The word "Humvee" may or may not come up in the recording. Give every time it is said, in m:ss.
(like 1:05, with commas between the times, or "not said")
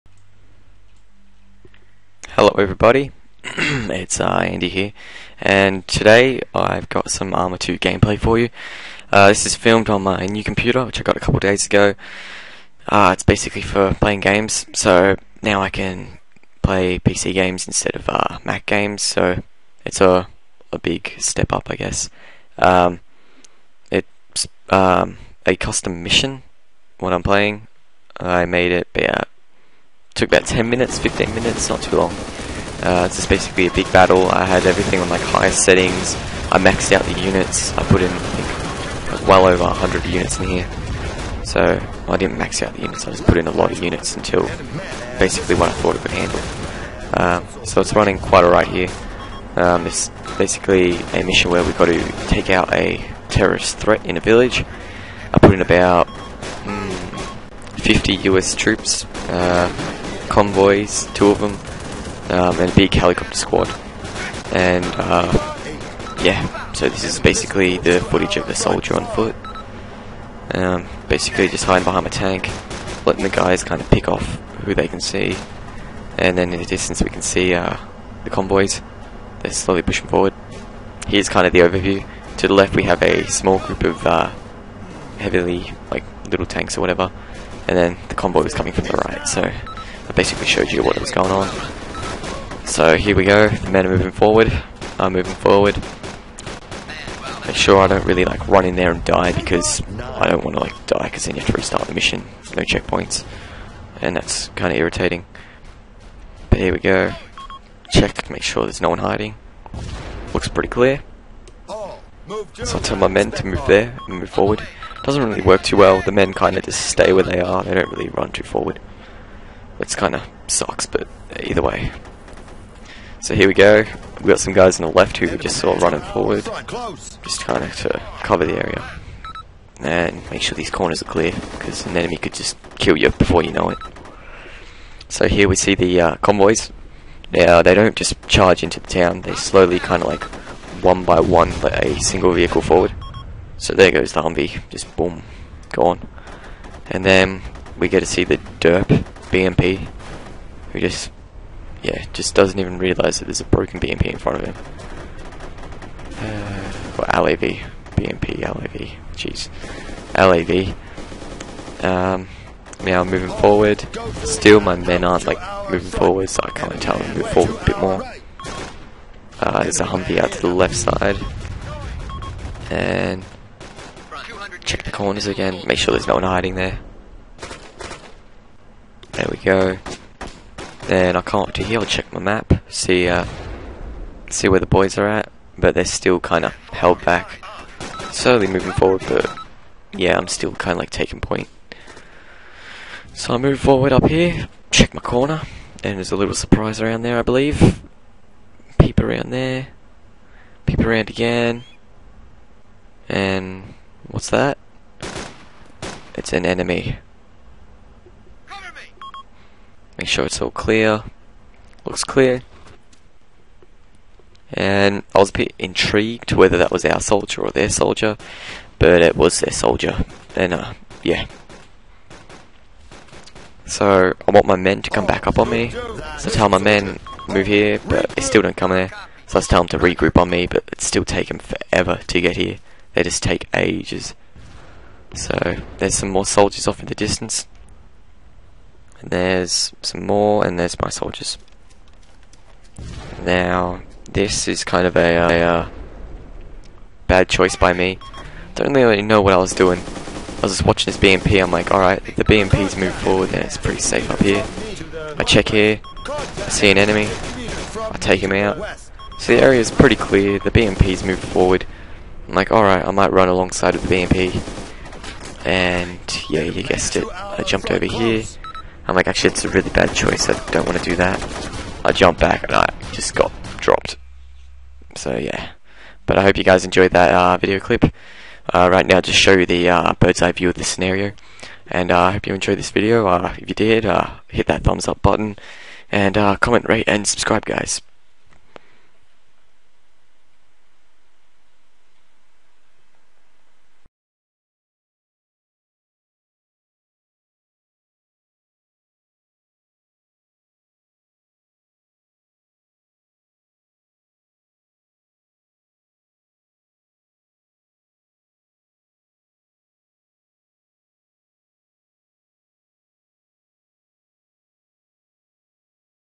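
2:24, 2:49.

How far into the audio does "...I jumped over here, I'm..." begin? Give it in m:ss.
4:27.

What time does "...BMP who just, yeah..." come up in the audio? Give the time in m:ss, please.
2:29.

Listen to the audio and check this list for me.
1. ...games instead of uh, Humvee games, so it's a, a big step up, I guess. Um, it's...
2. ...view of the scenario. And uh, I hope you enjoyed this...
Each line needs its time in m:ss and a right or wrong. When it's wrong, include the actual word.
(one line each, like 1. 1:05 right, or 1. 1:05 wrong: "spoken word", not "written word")
1. 0:17 wrong: "Mac", not "Humvee"
2. 4:40 right.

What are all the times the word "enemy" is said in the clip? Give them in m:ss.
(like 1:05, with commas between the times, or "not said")
2:11, 3:26, 4:16.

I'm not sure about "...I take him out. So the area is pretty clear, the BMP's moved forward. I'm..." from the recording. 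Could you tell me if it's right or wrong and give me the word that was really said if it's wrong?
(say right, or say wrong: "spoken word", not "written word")
right.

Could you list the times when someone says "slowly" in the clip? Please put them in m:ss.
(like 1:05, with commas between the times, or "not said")
1:19, 2:19, 3:08.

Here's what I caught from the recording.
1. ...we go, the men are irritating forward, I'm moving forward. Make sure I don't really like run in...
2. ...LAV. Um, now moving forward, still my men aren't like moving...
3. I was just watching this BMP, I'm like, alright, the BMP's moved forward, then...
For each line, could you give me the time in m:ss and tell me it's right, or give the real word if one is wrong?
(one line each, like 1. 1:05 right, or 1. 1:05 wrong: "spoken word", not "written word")
1. 1:33 wrong: "moving", not "irritating"
2. 2:40 right
3. 4:09 right.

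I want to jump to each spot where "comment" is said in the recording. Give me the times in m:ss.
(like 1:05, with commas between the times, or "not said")
4:46.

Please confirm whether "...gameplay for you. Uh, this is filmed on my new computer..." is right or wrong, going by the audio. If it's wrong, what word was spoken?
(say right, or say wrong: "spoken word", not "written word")
right.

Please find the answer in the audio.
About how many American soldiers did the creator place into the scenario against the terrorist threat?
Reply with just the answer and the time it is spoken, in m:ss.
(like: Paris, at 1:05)
50, at 0:57.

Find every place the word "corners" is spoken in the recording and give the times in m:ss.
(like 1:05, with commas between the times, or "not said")
2:10, 2:54, 3:15.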